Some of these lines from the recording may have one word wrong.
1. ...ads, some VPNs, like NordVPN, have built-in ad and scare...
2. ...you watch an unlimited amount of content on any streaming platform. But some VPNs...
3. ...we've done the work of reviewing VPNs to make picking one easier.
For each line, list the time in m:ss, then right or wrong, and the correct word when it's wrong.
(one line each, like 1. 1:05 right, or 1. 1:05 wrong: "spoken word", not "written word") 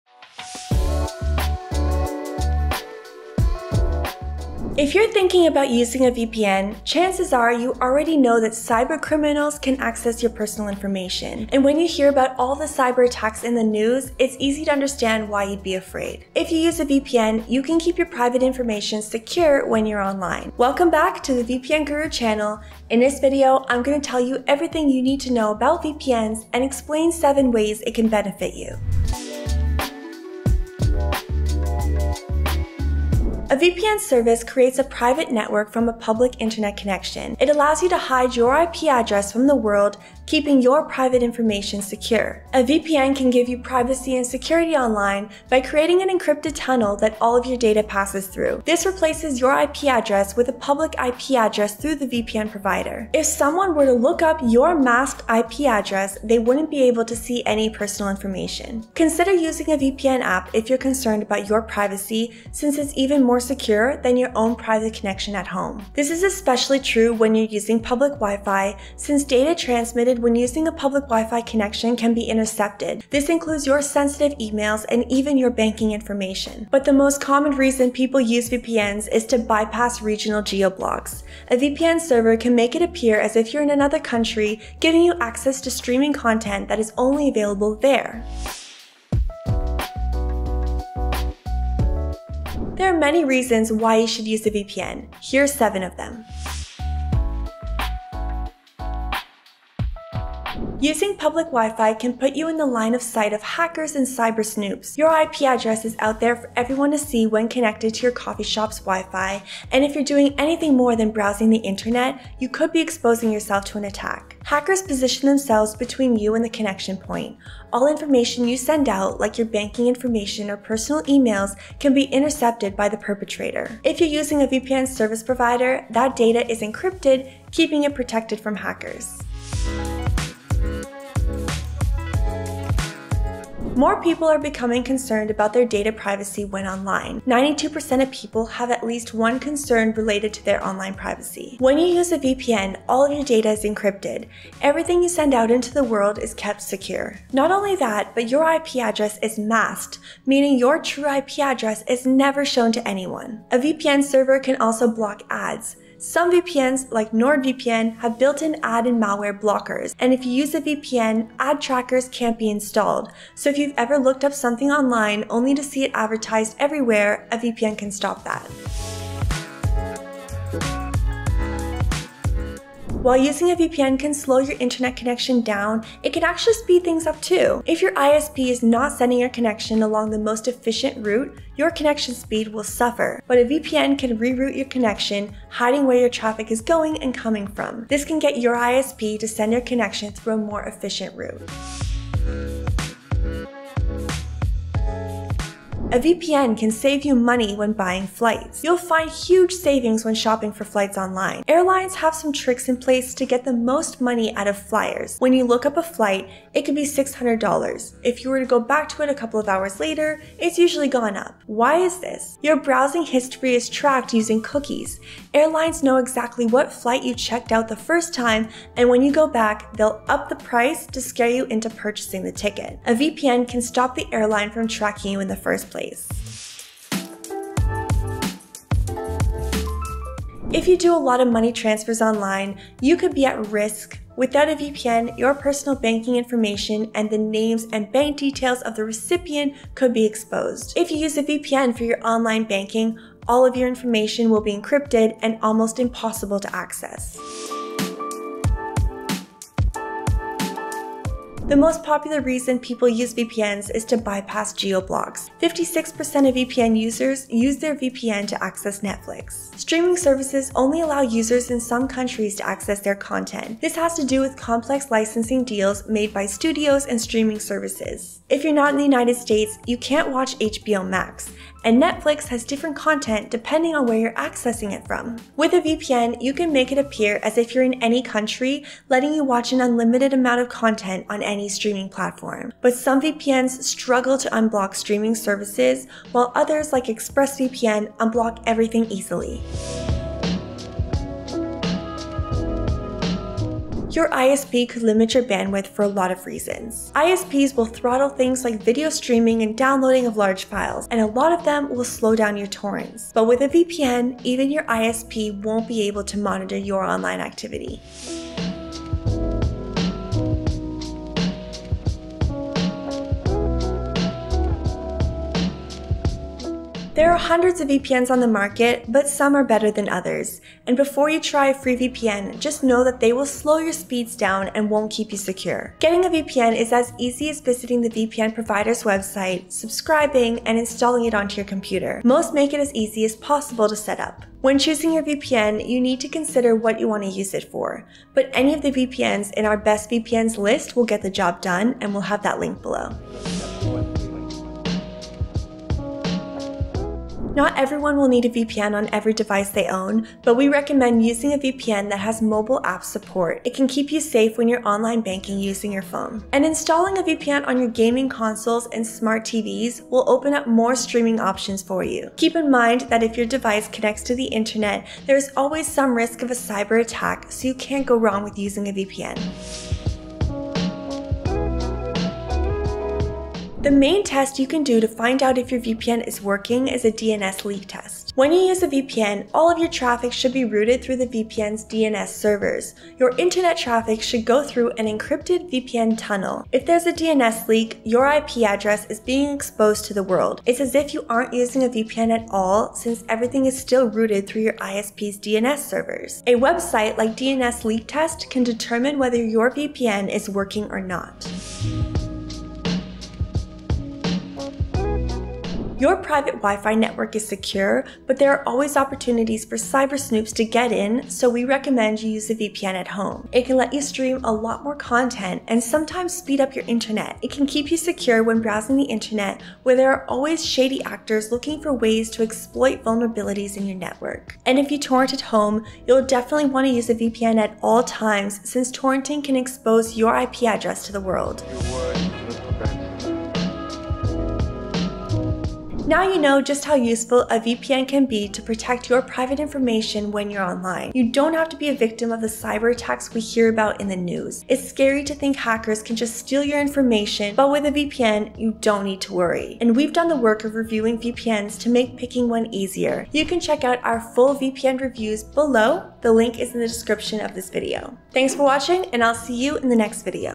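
1. 2:35 wrong: "malware", not "scare"
2. 4:39 right
3. 7:29 right.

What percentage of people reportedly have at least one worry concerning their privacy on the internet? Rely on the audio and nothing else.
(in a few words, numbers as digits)
92%.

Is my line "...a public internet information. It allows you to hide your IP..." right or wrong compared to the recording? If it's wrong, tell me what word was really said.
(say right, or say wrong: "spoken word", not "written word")
wrong: "connection", not "information".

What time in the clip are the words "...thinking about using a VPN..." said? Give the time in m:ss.
0:05.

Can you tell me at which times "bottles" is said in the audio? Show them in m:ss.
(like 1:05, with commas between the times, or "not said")
not said.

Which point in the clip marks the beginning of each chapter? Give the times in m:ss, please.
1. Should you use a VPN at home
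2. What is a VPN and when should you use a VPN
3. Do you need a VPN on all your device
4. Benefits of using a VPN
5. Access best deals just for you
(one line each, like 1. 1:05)
1. 6:43
2. 0:32
3. 5:43
4. 1:31
5. 7:33.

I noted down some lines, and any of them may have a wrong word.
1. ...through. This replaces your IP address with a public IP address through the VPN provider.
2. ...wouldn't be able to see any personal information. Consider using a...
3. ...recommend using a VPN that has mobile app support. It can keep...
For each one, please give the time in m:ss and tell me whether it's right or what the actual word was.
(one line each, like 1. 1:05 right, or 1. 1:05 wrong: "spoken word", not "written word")
1. 0:48 right
2. 0:56 right
3. 5:50 right.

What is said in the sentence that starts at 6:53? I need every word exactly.
It can let you stream a lot more content and sometimes speed up your internet.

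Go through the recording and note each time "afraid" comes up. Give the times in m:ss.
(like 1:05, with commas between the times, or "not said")
0:15.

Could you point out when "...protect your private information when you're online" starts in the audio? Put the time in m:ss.
7:18.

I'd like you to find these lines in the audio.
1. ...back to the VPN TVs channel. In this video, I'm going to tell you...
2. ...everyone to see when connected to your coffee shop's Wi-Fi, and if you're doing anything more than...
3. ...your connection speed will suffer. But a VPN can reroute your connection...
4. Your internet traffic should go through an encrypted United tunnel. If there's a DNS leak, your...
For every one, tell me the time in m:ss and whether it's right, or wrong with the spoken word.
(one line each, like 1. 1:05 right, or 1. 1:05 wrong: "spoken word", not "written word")
1. 0:20 wrong: "Guru", not "TVs"
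2. 1:46 right
3. 3:01 right
4. 6:22 wrong: "VPN", not "United".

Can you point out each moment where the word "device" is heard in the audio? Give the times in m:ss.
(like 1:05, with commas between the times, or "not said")
5:49, 6:03.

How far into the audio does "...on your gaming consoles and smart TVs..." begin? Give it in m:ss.
5:57.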